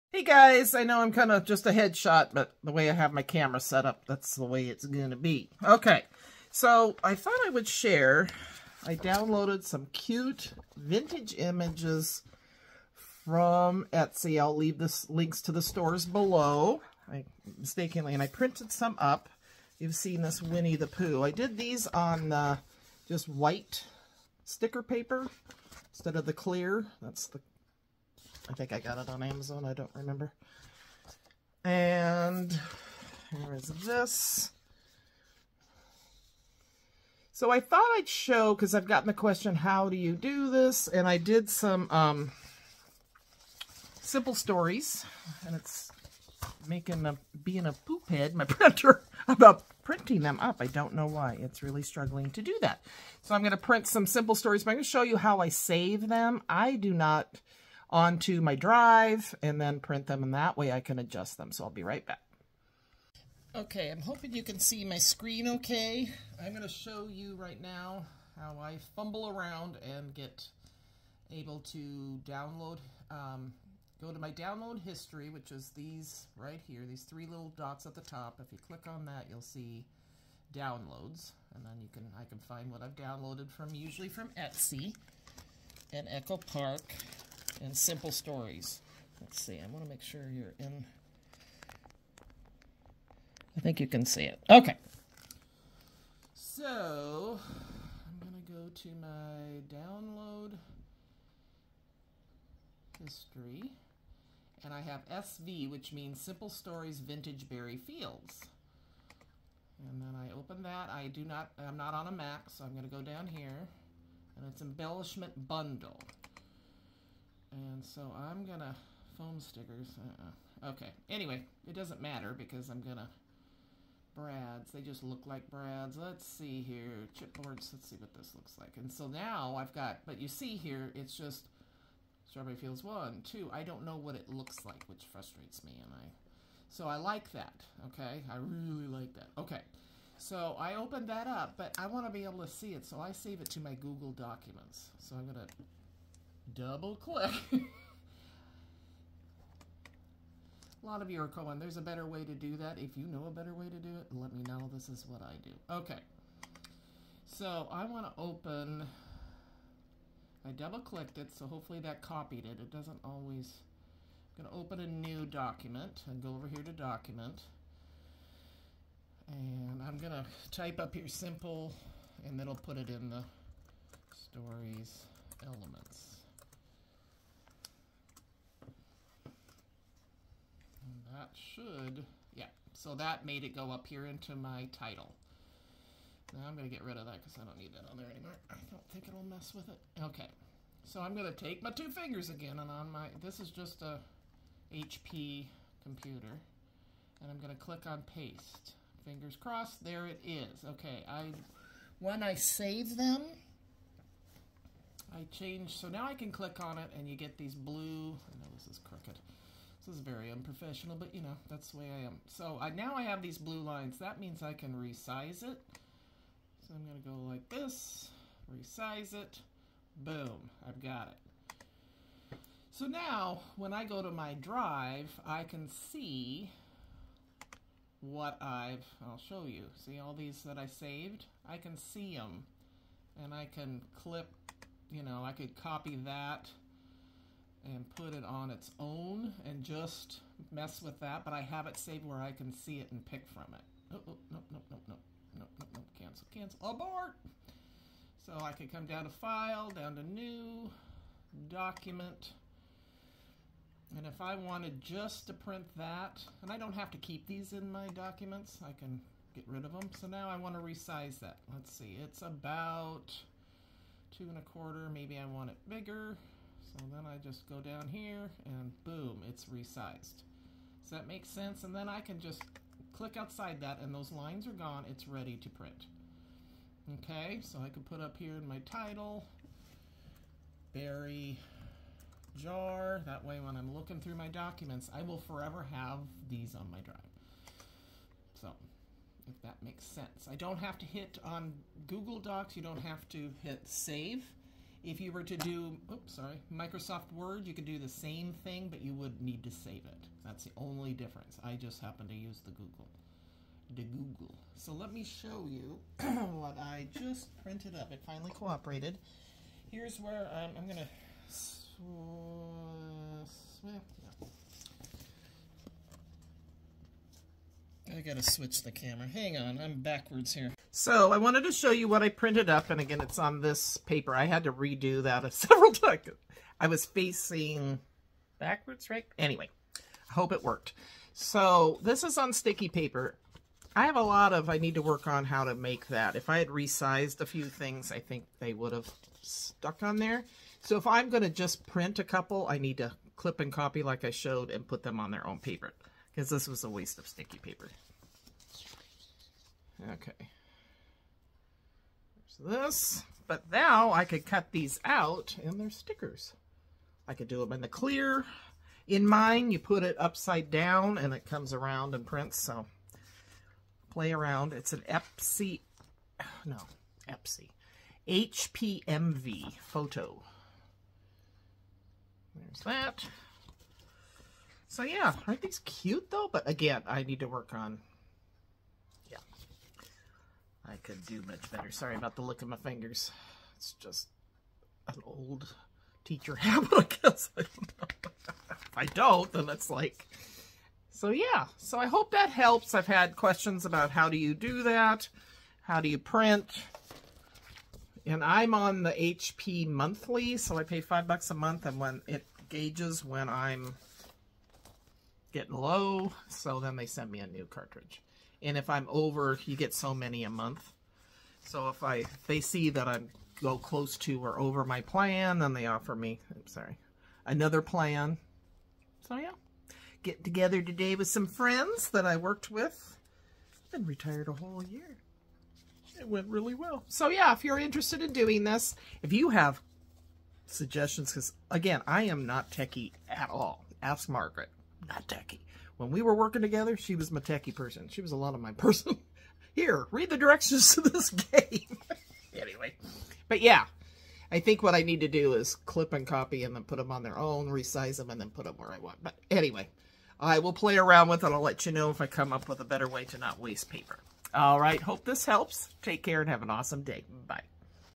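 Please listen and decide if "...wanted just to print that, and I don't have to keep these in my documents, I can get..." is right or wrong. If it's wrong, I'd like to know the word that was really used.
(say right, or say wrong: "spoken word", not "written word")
right.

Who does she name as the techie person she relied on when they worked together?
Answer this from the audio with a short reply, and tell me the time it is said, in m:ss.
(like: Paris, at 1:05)
Margaret, at 7:14.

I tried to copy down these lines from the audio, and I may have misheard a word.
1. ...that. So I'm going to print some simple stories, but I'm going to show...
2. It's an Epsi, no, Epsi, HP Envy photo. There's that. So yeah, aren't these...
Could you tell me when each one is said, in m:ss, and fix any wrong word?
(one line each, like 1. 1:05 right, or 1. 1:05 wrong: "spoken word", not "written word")
1. 0:52 right
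2. 6:04 right.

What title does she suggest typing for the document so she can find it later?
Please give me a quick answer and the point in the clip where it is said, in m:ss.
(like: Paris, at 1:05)
Berry jar, at 4:40.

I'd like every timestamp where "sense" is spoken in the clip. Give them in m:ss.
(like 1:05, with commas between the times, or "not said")
4:31, 4:49.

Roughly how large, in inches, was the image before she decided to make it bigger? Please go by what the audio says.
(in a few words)
2 and a quarter.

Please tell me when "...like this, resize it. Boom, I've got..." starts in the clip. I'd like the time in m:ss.
3:37.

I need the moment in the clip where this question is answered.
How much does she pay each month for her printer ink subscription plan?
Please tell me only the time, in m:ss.
6:40.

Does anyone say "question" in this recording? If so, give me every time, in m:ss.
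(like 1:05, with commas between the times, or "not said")
0:39, 6:33.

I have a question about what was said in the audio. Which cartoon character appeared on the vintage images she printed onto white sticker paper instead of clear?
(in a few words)
Winnie the Pooh.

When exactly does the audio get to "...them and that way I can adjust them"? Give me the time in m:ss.
1:00.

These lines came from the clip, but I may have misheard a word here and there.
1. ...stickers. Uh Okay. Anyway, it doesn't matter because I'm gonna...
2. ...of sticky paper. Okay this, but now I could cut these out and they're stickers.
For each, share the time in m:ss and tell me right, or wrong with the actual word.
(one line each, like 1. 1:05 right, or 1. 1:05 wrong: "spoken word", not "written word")
1. 1:59 right
2. 5:46 right.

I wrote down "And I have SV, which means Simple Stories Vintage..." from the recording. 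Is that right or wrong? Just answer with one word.
right.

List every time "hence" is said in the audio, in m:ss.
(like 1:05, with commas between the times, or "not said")
not said.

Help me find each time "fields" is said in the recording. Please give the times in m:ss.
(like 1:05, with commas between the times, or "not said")
1:47, 2:12.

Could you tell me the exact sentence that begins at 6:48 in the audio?
And if I'm over, you get so many a month.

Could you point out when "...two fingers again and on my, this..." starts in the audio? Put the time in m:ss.
3:11.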